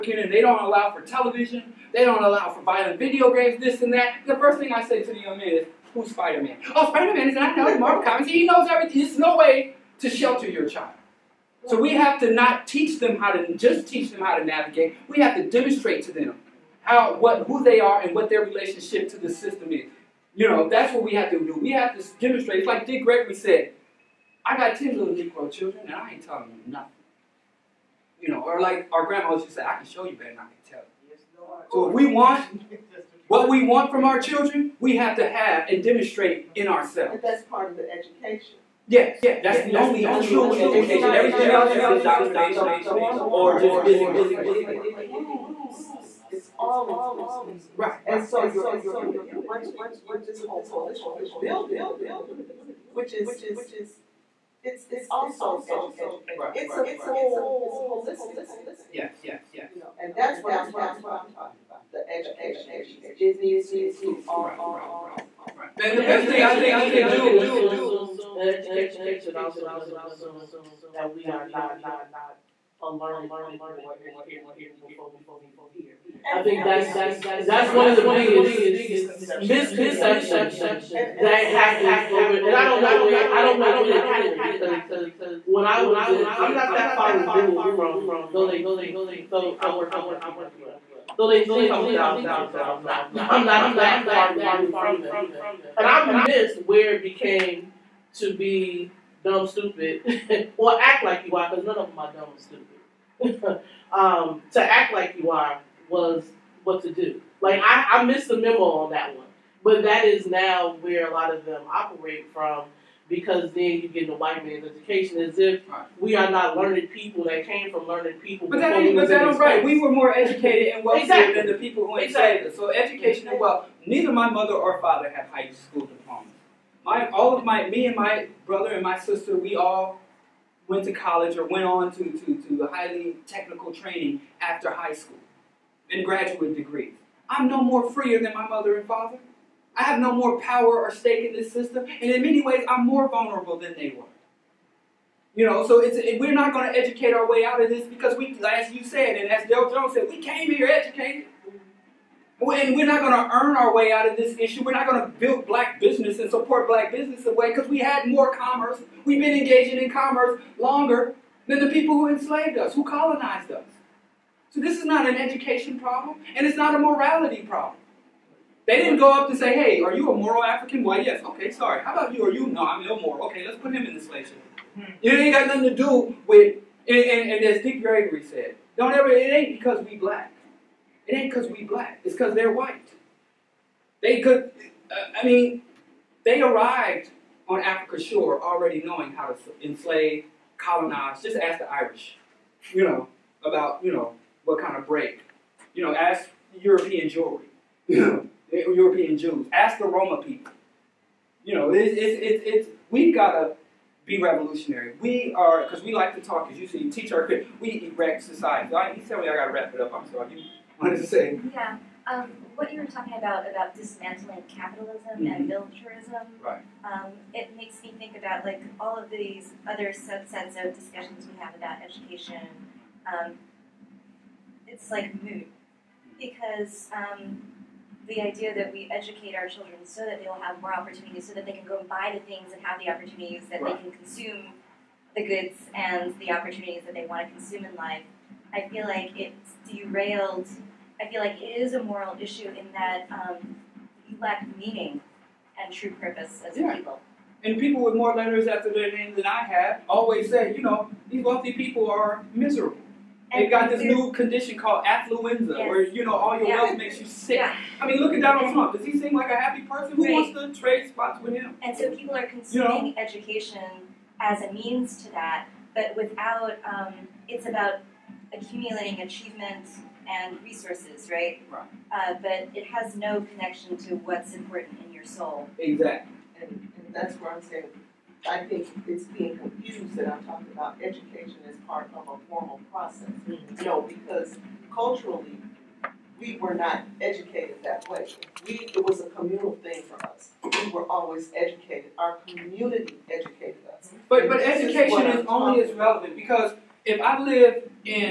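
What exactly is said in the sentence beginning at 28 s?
You know, or like our grandmothers used to say, I can show you better than I can tell you.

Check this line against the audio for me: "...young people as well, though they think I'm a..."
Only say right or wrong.
right.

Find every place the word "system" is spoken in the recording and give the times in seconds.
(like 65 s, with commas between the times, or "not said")
19 s, 141 s.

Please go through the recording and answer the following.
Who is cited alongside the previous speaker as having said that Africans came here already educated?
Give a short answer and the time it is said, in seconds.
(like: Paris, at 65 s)
Del Jones, at 149 s.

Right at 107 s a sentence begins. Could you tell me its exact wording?
Like, I, I missed the memo on that one.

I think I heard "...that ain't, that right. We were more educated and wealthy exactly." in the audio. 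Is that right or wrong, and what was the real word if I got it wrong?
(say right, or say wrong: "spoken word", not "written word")
right.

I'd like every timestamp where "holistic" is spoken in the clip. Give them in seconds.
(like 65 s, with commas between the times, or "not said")
57 s.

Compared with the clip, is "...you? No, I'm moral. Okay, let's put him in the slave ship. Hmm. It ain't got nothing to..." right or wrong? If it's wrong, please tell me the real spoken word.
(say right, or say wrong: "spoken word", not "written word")
wrong: "immoral", not "moral".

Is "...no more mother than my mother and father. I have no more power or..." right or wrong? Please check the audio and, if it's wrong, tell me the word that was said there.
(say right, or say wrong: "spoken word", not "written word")
wrong: "freer", not "mother".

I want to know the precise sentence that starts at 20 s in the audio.
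You know, that's what we have to do.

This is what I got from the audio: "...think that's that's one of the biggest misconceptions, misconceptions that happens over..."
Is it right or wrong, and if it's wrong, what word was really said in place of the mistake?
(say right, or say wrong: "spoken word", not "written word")
right.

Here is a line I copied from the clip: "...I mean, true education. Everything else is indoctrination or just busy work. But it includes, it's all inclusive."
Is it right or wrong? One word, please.
right.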